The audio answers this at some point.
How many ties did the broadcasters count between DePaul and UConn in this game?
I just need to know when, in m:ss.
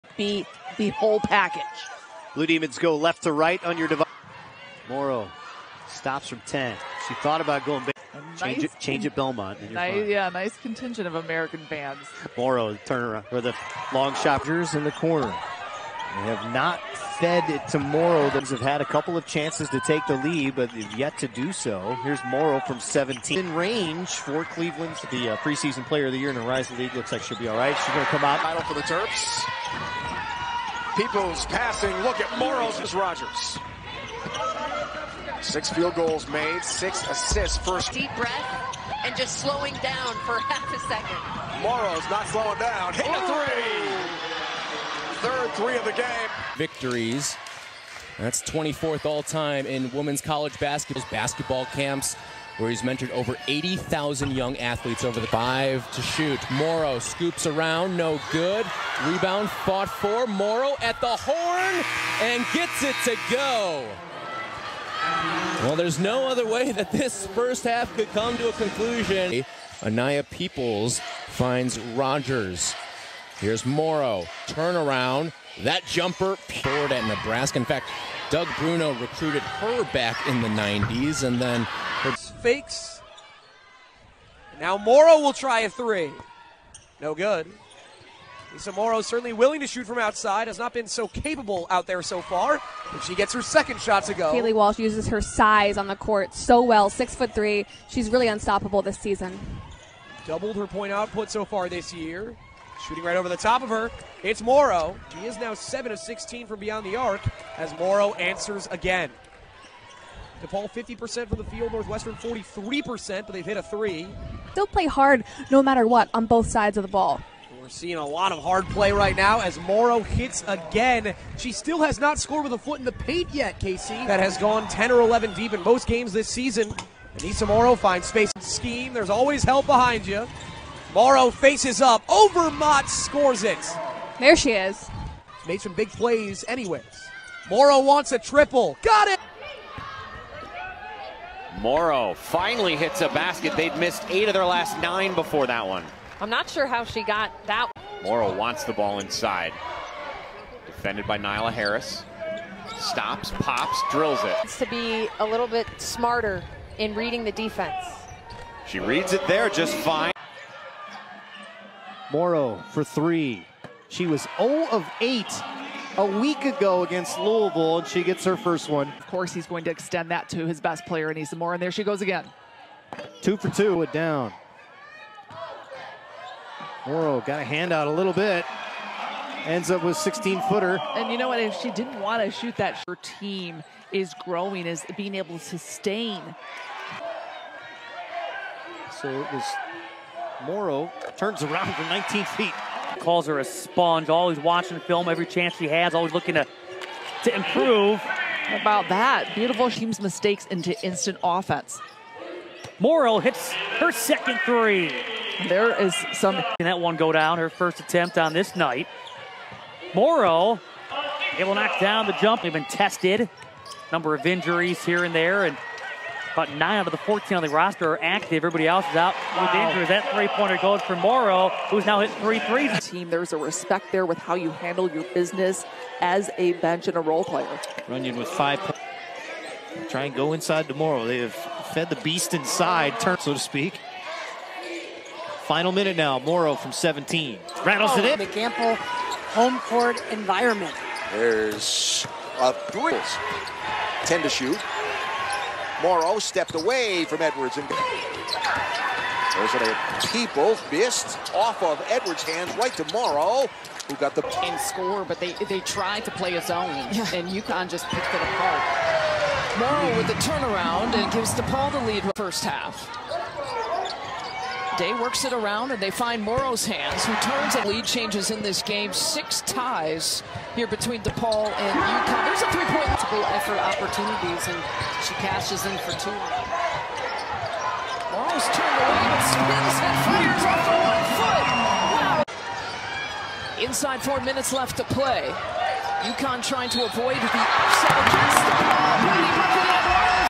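4:28.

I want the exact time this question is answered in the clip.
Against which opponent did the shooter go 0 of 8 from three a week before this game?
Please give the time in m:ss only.
2:47.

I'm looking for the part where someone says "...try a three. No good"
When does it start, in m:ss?
1:25.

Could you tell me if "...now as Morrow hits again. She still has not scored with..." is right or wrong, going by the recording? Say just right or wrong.
right.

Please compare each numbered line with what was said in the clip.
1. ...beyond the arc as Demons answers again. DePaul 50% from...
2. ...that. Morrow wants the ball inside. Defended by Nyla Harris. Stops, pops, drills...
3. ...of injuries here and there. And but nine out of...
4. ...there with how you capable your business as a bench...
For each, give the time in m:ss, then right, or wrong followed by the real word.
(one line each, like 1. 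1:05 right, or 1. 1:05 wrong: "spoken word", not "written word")
1. 1:46 wrong: "Morrow", not "Demons"
2. 2:27 right
3. 3:34 right
4. 3:43 wrong: "handle", not "capable".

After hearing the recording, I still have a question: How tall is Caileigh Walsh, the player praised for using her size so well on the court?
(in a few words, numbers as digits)
6'3".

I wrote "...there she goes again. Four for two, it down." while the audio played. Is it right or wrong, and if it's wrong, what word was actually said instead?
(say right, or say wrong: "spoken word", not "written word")
wrong: "Two", not "Four".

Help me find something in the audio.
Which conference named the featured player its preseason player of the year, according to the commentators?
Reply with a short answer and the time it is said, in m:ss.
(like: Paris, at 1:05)
Horizon League, at 0:26.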